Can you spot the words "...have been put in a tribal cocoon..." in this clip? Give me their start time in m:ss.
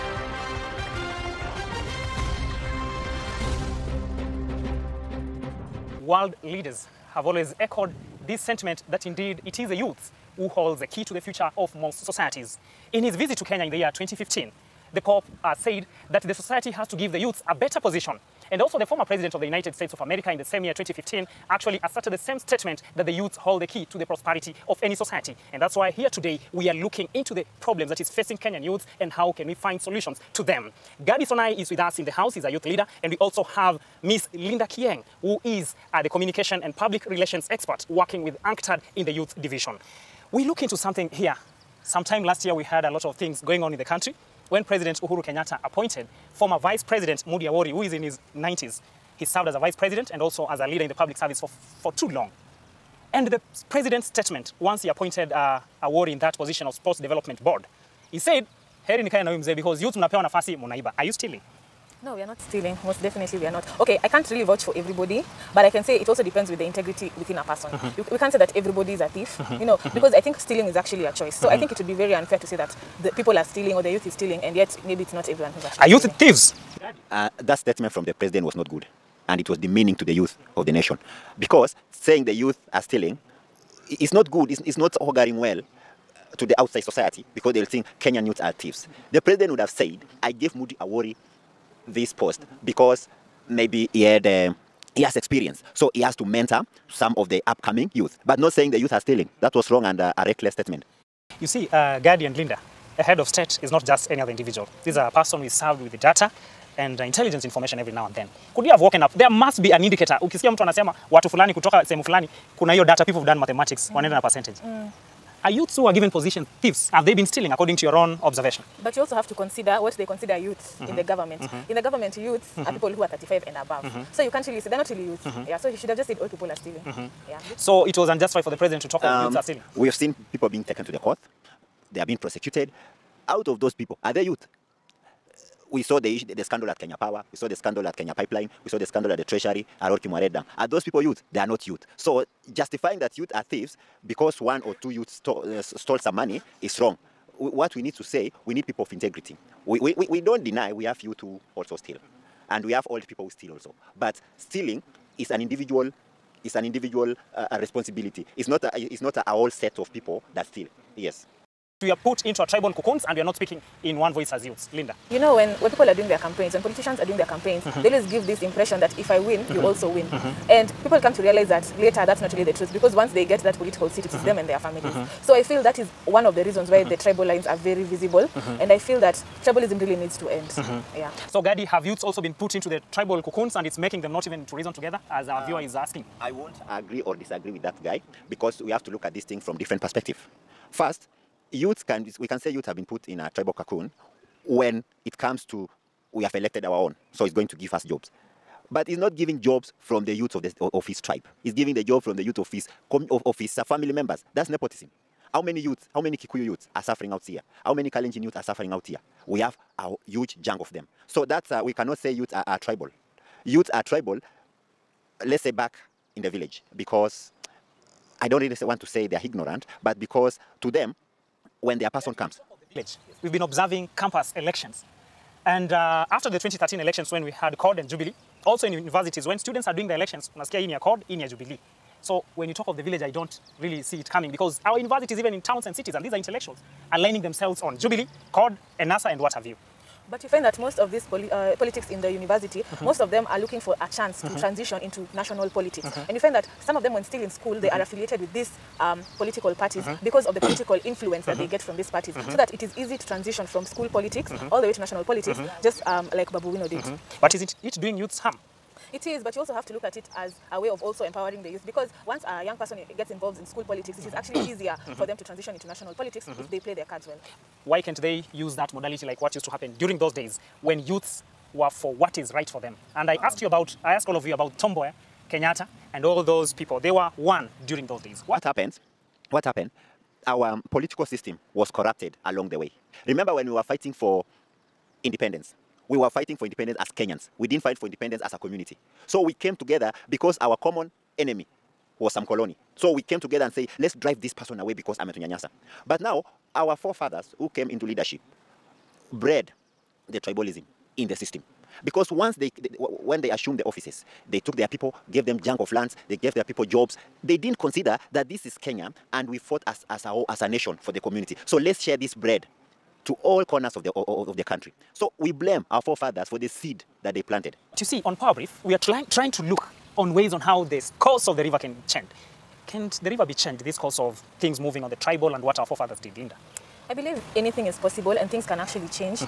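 3:12.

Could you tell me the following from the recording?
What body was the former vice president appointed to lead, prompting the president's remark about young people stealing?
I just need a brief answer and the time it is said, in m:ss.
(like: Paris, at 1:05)
Sports Development Board, at 0:56.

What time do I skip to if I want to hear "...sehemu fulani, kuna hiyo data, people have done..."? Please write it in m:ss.
1:51.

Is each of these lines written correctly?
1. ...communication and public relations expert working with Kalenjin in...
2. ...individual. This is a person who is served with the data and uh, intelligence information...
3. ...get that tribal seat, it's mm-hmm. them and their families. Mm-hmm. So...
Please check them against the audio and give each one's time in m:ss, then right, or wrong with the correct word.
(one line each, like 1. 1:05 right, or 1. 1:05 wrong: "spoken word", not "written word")
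1. 0:36 wrong: "UNCTAD", not "Kalenjin"
2. 1:44 right
3. 2:53 wrong: "political", not "tribal".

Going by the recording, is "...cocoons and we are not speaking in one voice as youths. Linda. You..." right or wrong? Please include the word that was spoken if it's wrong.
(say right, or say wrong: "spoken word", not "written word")
right.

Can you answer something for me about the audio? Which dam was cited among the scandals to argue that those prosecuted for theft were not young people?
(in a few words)
Arror Kimwarer Dam.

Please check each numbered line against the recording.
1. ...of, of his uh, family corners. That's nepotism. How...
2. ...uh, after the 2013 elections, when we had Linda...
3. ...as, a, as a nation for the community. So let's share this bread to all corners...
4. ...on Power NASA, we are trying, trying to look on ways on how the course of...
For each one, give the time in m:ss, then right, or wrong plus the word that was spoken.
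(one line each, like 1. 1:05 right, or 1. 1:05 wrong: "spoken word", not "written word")
1. 3:22 wrong: "members", not "corners"
2. 3:45 wrong: "CORD", not "Linda"
3. 5:09 right
4. 5:18 wrong: "Brief", not "NASA".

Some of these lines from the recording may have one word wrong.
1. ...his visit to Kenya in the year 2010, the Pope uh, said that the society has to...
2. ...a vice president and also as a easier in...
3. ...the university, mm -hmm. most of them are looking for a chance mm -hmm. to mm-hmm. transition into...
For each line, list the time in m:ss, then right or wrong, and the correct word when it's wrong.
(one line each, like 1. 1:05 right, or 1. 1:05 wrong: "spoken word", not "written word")
1. 0:13 wrong: "2015", not "2010"
2. 0:49 wrong: "leader", not "easier"
3. 4:02 right.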